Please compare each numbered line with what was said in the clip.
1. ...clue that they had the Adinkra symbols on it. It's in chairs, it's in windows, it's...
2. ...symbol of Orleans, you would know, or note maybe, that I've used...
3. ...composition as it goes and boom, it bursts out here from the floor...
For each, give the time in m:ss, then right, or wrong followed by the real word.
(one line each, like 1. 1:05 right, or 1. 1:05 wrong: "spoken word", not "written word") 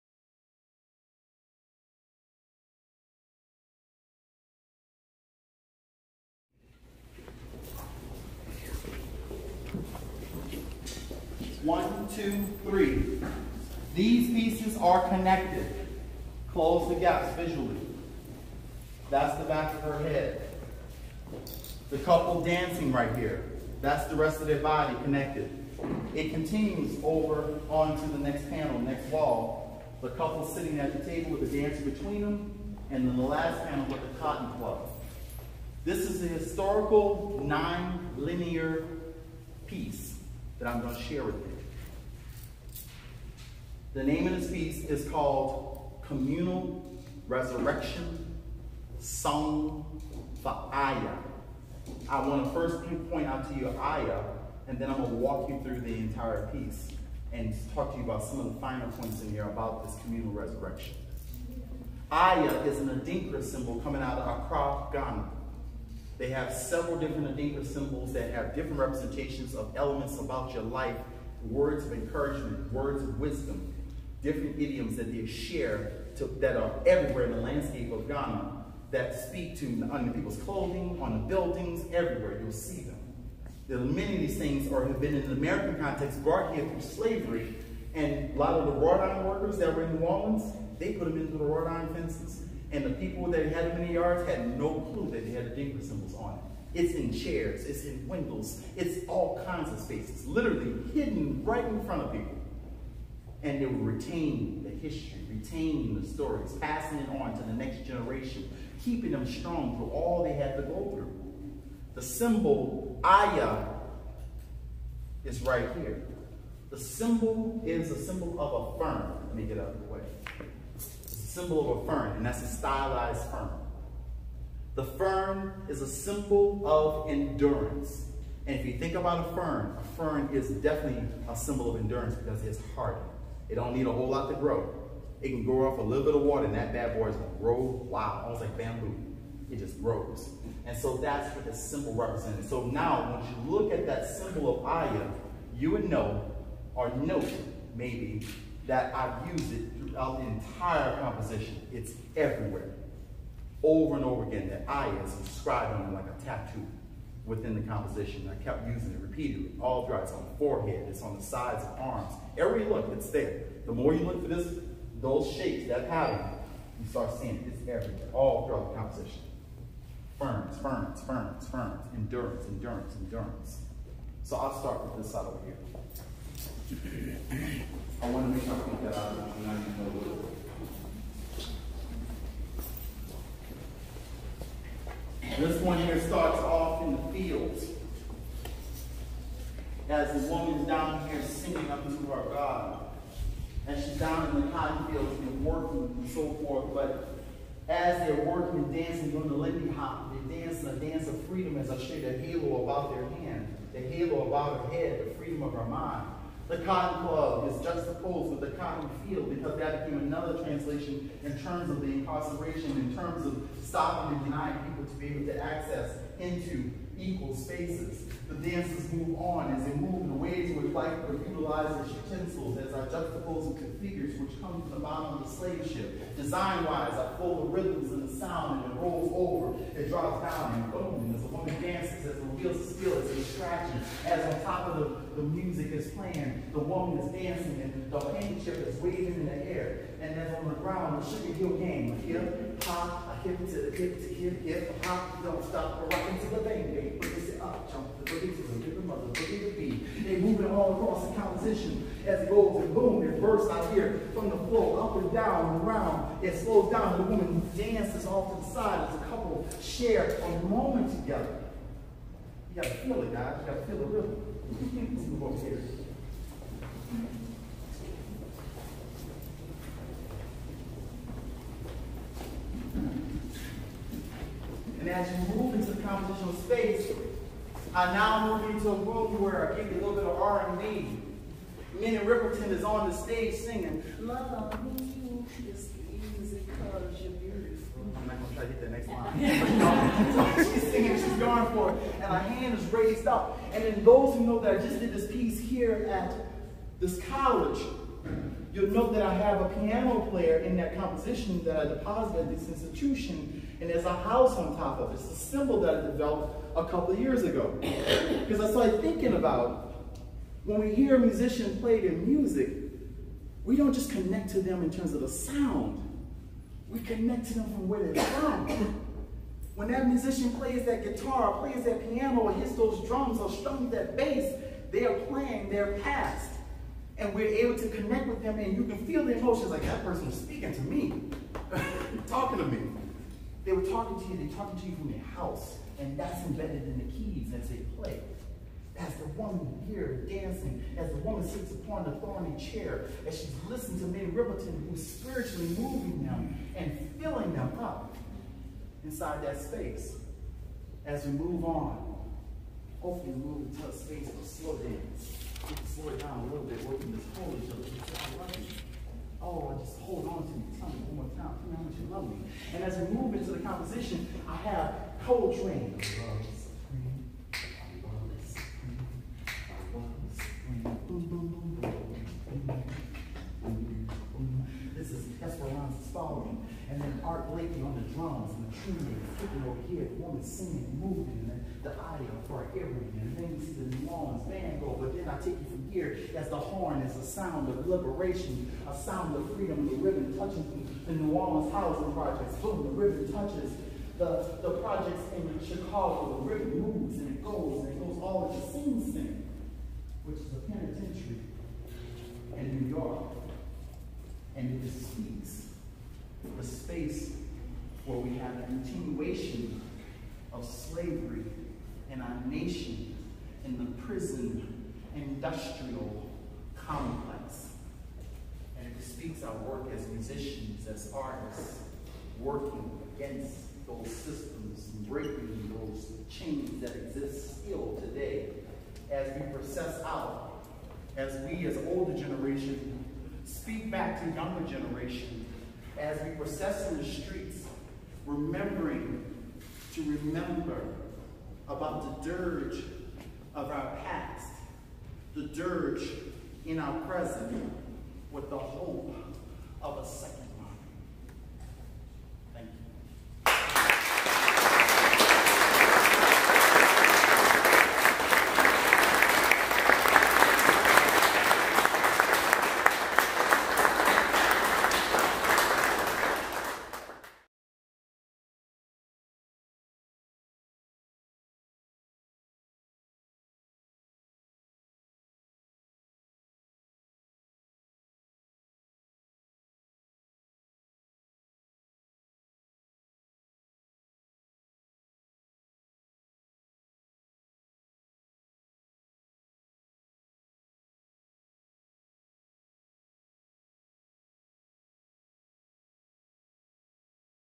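1. 1:34 right
2. 2:24 wrong: "Aya", not "Orleans"
3. 4:11 right.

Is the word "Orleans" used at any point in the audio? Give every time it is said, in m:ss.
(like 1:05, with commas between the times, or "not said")
1:30, 6:23, 6:31.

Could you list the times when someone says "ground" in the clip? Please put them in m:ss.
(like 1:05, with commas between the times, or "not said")
4:00.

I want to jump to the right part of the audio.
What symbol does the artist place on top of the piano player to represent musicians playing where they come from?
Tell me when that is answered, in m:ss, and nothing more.
5:03.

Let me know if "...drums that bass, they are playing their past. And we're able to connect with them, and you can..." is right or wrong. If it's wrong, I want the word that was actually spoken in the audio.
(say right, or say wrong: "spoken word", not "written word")
wrong: "strums", not "drums".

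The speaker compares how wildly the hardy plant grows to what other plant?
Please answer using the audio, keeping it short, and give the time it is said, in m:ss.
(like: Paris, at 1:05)
Bamboo, at 2:18.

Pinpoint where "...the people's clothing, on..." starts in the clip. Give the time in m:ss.
1:20.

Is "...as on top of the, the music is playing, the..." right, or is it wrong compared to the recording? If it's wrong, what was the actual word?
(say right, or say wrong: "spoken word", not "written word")
right.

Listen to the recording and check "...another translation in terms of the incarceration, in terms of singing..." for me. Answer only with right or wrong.
wrong.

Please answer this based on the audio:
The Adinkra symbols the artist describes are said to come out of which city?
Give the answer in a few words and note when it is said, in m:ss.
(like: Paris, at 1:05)
Accra, at 1:04.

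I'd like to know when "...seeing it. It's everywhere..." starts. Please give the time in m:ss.
2:47.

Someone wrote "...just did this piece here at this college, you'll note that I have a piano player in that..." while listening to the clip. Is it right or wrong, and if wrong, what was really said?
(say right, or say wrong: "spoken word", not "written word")
right.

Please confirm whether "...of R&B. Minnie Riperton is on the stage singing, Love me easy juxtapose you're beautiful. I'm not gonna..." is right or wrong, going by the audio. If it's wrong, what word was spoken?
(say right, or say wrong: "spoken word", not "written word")
wrong: "cause", not "juxtapose".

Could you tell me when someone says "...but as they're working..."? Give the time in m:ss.
3:16.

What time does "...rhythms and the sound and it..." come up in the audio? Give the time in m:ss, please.
3:47.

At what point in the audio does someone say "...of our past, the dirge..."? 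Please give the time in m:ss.
7:23.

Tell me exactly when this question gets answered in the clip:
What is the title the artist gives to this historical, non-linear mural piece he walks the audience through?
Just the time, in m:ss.
0:46.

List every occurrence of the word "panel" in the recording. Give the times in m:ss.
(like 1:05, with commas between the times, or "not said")
0:28, 0:33.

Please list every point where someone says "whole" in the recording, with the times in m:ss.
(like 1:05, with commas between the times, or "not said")
2:13, 5:57.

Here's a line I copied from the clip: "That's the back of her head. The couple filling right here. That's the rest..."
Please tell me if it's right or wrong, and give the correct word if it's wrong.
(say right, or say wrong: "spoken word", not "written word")
wrong: "dancing", not "filling".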